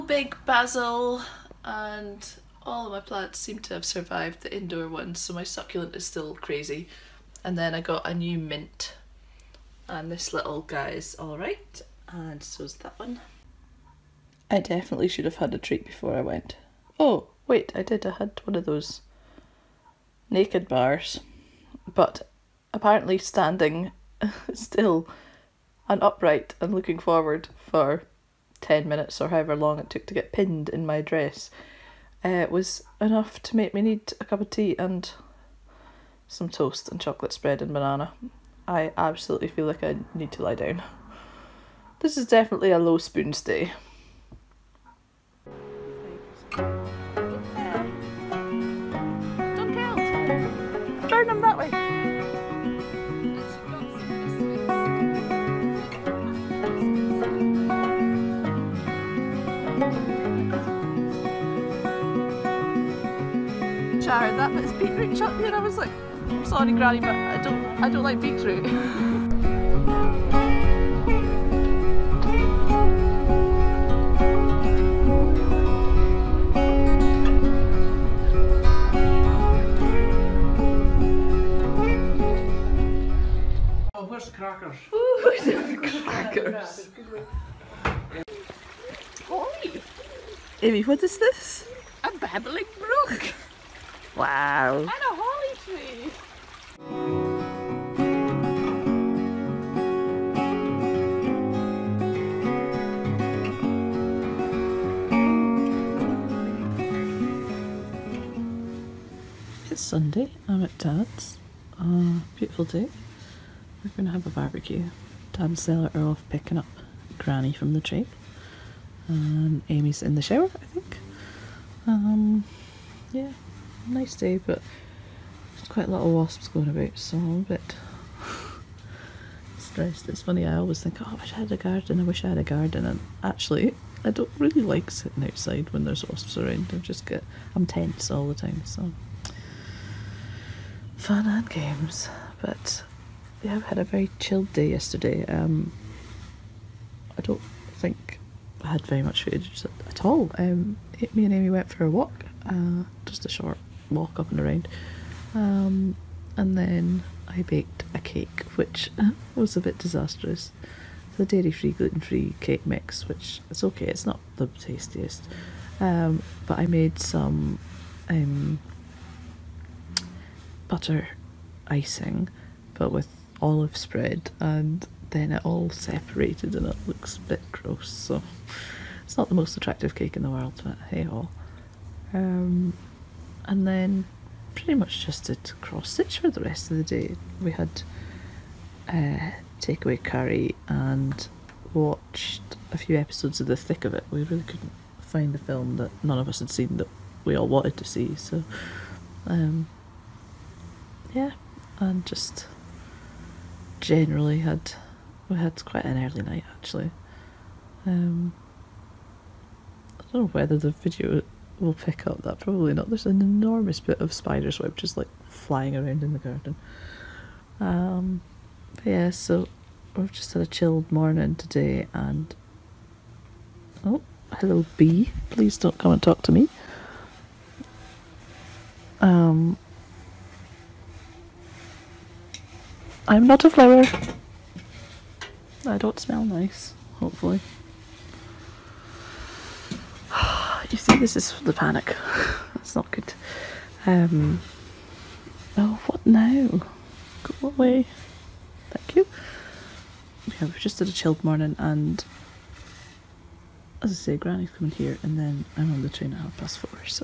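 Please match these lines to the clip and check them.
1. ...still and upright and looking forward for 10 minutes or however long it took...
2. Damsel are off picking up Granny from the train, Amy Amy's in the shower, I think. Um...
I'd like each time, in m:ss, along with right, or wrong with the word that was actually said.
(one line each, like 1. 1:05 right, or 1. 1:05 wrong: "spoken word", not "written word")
1. 0:24 right
2. 1:55 wrong: "And", not "Amy".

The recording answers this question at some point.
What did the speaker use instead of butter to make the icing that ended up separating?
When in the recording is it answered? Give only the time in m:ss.
2:53.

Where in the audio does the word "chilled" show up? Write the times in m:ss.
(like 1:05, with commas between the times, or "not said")
2:24, 3:40, 4:10.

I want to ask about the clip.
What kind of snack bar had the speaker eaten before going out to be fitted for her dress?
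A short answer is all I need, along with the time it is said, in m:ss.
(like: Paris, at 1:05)
naked bars, at 0:20.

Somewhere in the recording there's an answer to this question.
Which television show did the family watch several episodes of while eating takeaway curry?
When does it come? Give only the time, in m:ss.
3:13.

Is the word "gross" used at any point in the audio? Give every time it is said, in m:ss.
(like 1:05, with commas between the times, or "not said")
2:57.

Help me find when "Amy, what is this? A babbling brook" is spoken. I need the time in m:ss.
1:30.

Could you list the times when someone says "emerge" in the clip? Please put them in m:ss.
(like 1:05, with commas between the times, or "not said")
not said.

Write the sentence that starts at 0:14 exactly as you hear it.
I definitely should have had a treat before I went.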